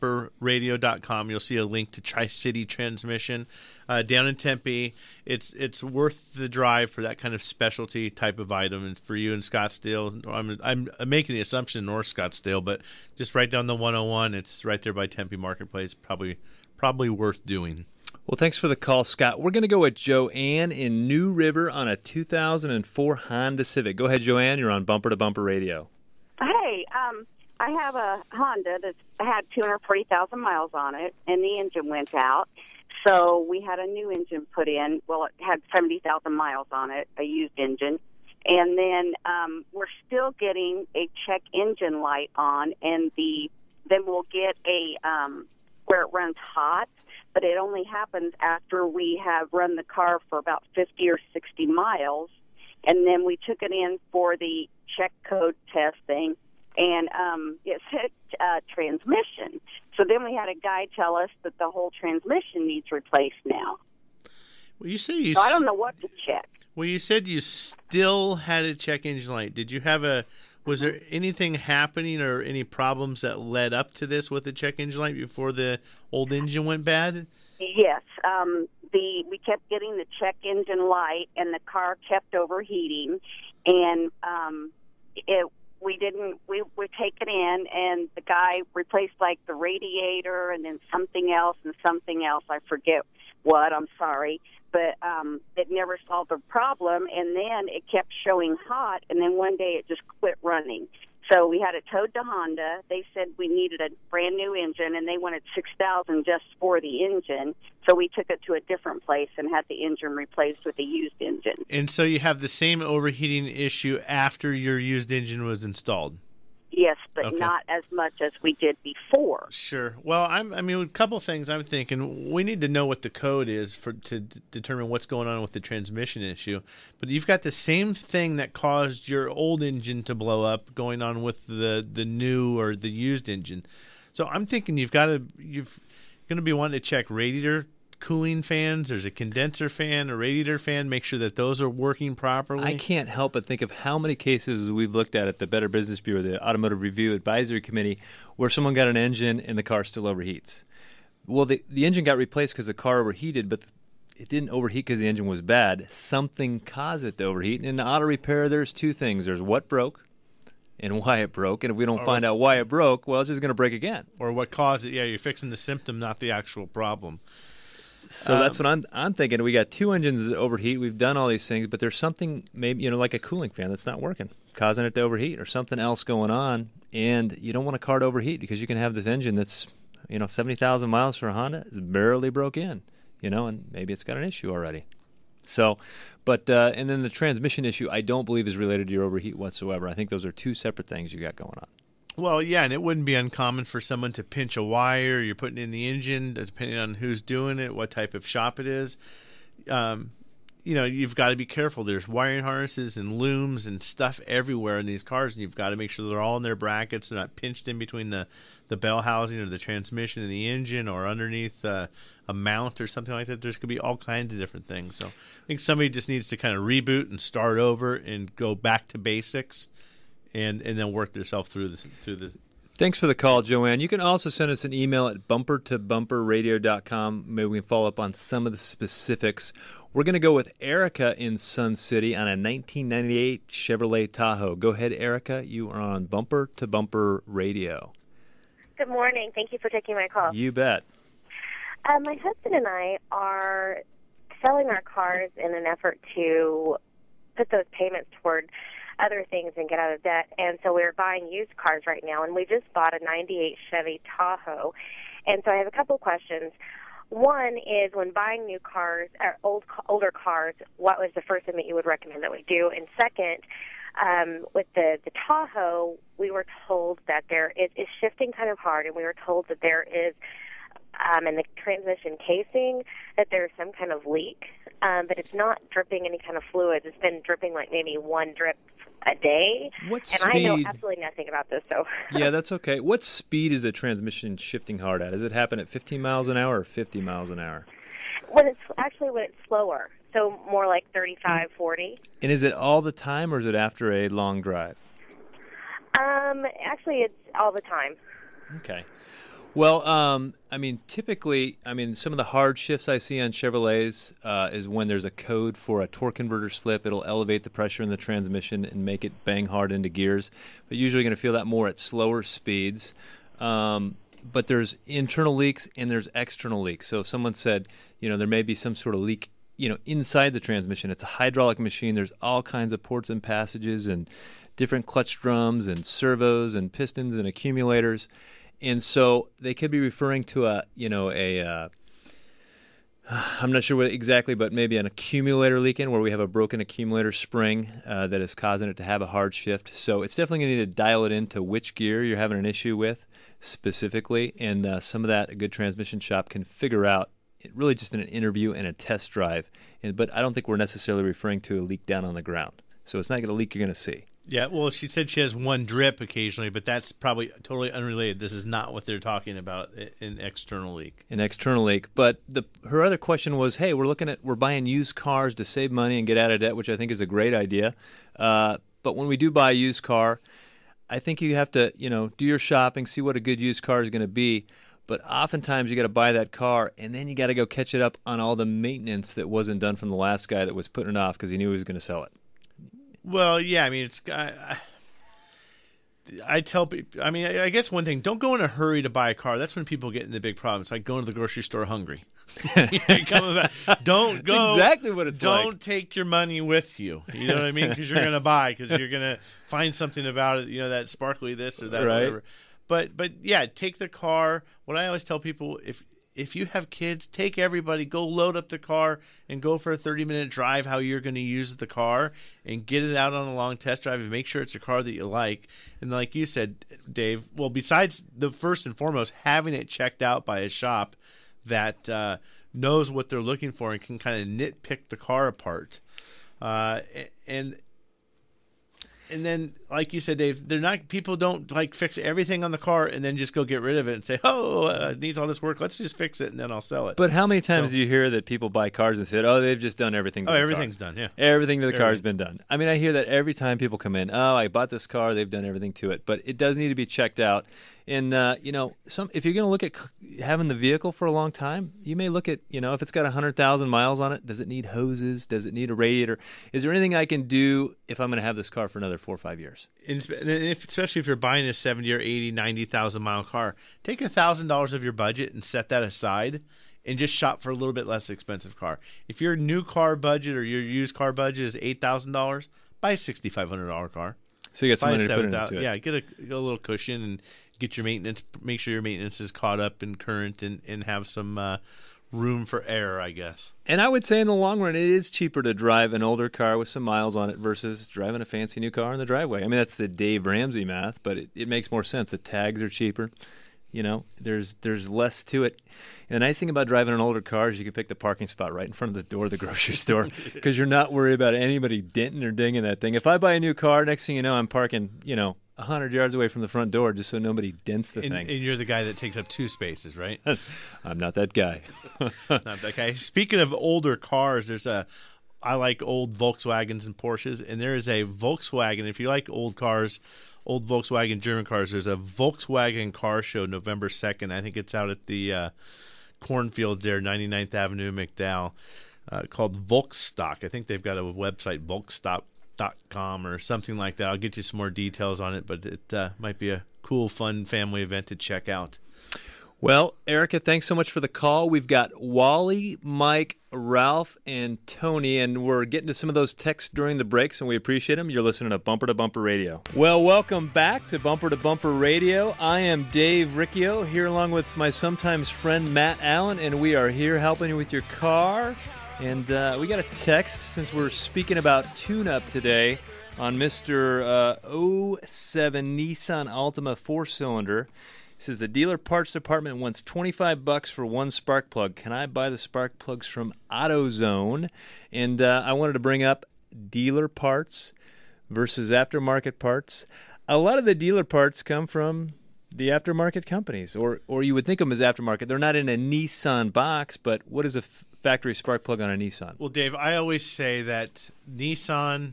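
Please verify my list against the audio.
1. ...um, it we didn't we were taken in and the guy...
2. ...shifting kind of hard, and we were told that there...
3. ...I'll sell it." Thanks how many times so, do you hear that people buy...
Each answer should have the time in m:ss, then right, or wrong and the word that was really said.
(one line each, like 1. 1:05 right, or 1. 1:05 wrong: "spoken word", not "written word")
1. 1:24 right
2. 4:28 right
3. 7:16 wrong: "But", not "Thanks".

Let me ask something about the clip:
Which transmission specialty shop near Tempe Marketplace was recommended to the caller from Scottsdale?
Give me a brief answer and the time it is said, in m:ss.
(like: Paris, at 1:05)
Tri City Transmission, at 0:02.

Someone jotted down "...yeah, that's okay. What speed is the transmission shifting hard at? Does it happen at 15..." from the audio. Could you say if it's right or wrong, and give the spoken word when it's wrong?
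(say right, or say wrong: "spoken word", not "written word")
right.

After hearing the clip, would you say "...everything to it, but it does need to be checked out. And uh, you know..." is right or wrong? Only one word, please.
right.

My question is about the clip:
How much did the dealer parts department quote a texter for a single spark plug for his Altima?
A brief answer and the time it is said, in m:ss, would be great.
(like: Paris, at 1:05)
$25, at 9:29.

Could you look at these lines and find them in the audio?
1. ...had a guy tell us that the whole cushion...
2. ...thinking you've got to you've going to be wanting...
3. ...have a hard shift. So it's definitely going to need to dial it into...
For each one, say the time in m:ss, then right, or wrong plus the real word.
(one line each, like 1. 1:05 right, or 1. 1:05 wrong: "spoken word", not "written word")
1. 1:00 wrong: "transmission", not "cushion"
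2. 2:14 right
3. 5:38 right.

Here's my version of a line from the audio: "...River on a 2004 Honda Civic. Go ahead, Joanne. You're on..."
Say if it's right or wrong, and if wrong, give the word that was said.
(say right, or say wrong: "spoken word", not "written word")
right.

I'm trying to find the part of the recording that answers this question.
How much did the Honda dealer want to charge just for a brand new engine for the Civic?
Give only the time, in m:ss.
1:45.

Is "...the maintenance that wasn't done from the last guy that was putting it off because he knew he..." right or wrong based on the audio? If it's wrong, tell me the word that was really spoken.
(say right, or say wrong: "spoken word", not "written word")
right.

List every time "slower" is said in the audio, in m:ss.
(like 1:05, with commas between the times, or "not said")
4:49, 5:11.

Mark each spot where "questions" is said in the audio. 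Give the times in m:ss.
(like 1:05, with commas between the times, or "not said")
4:15, 6:02.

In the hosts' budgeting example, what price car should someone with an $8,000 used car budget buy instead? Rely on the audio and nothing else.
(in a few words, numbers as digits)
$6,500.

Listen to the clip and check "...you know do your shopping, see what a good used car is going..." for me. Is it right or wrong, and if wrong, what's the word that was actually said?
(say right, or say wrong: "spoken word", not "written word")
right.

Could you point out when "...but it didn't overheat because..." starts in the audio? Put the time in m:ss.
2:33.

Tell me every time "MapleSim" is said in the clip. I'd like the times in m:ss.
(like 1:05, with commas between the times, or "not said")
not said.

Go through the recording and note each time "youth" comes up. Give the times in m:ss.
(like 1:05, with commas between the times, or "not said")
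not said.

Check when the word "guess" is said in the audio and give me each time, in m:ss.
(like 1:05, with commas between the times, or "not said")
6:27, 8:03.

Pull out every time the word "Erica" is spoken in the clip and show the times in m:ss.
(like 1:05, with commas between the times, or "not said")
3:50, 3:54, 9:00.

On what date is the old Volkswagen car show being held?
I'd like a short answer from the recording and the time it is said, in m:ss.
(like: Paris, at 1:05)
November 2, at 8:43.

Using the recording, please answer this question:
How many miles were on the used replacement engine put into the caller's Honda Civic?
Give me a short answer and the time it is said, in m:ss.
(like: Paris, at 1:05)
70,000, at 0:35.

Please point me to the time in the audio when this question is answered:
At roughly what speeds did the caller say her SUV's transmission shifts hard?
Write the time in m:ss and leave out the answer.
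4:50.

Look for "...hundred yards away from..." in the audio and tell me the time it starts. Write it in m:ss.
8:25.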